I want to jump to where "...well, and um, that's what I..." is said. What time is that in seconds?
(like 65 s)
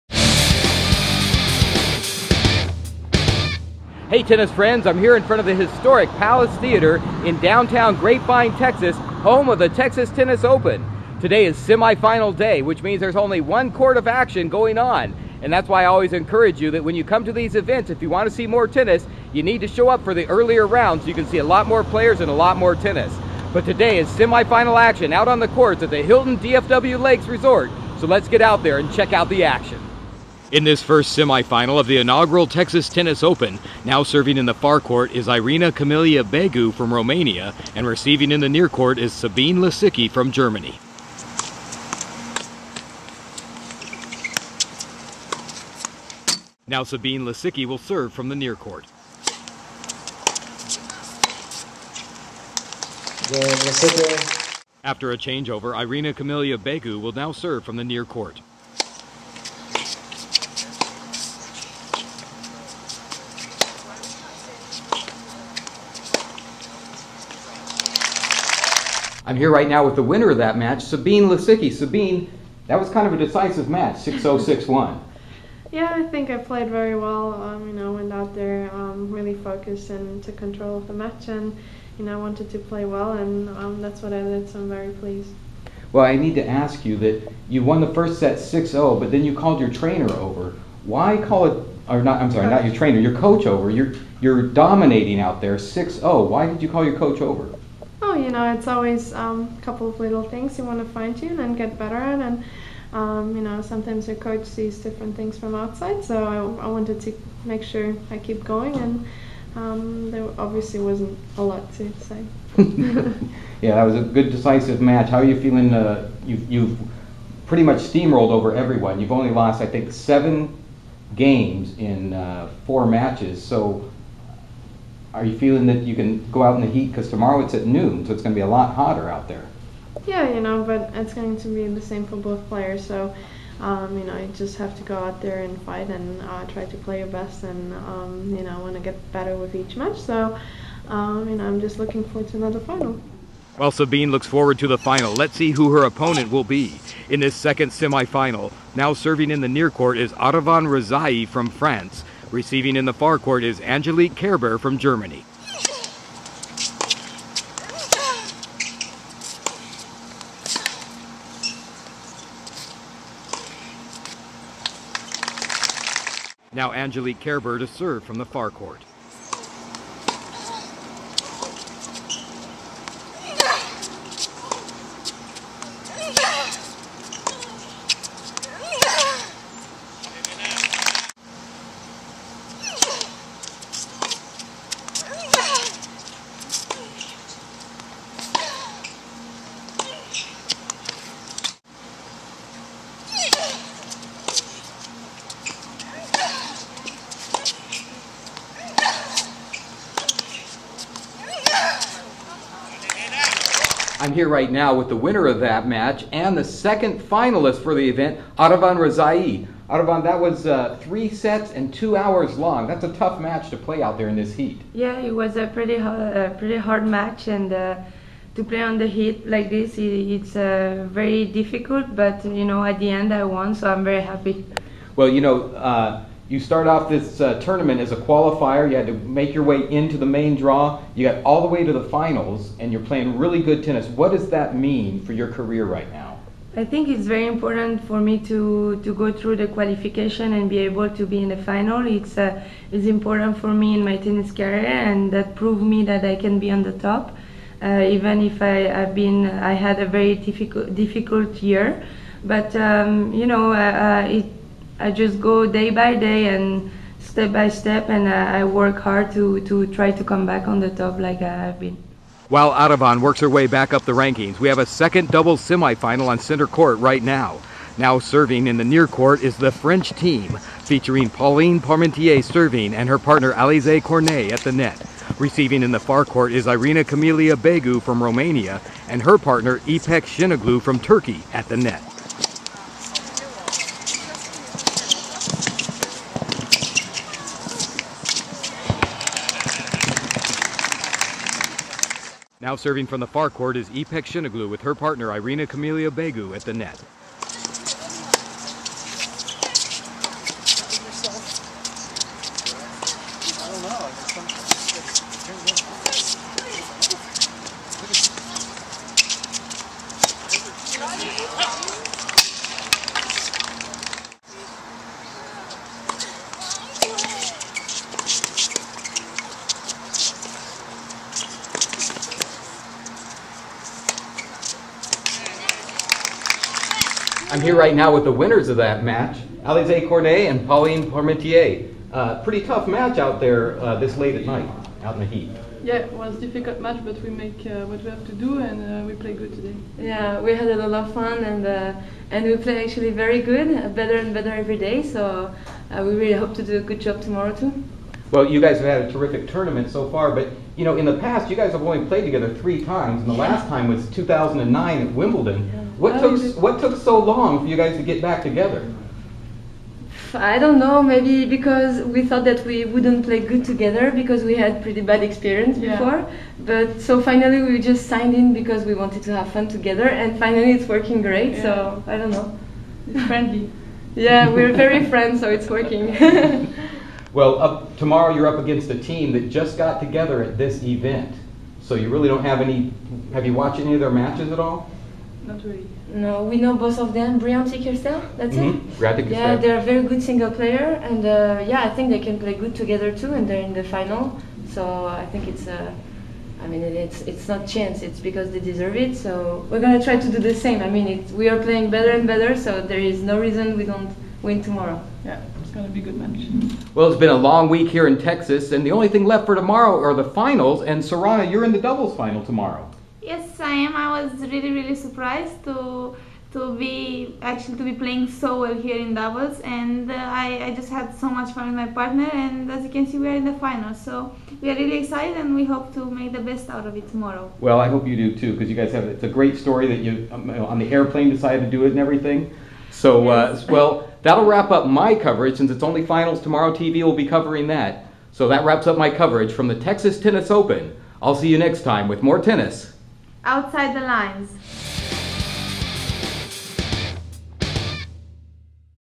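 82 s.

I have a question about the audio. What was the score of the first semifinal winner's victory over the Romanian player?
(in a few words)
6-0, 6-1.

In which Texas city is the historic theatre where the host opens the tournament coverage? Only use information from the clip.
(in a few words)
Grapevine.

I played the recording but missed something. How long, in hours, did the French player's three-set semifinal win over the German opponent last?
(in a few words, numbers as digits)
2 hours.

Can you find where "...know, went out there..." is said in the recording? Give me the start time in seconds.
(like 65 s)
77 s.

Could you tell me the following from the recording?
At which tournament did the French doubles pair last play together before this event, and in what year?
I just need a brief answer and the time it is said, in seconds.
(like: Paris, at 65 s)
Wimbledon 2009, at 353 s.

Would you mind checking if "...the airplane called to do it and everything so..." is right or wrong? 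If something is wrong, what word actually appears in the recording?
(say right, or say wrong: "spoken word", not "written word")
wrong: "decided", not "called".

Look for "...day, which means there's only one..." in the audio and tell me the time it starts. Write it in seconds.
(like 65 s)
12 s.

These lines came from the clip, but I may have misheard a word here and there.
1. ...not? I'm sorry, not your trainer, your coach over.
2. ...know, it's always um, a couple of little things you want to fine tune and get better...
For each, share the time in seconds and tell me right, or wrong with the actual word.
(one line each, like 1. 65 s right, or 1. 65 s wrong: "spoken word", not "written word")
1. 92 s right
2. 98 s right.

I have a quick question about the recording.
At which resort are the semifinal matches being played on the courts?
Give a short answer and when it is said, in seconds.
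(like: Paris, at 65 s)
Hilton DFW Lakes Resort, at 26 s.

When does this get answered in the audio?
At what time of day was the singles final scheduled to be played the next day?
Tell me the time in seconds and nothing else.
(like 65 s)
127 s.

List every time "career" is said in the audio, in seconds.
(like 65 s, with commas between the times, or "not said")
235 s, 244 s.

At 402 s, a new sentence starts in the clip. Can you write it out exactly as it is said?
So there is no reason we don't win tomorrow.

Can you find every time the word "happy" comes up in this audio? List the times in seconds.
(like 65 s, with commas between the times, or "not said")
224 s.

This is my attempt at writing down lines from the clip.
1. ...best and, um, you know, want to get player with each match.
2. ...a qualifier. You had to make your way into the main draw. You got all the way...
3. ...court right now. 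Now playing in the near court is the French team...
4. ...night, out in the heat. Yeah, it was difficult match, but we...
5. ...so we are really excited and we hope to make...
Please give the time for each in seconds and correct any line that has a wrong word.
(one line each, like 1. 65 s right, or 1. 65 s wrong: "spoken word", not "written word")
1. 137 s wrong: "better", not "player"
2. 227 s right
3. 266 s wrong: "serving", not "playing"
4. 334 s right
5. 423 s right.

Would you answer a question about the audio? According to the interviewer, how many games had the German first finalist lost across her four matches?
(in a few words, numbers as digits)
7.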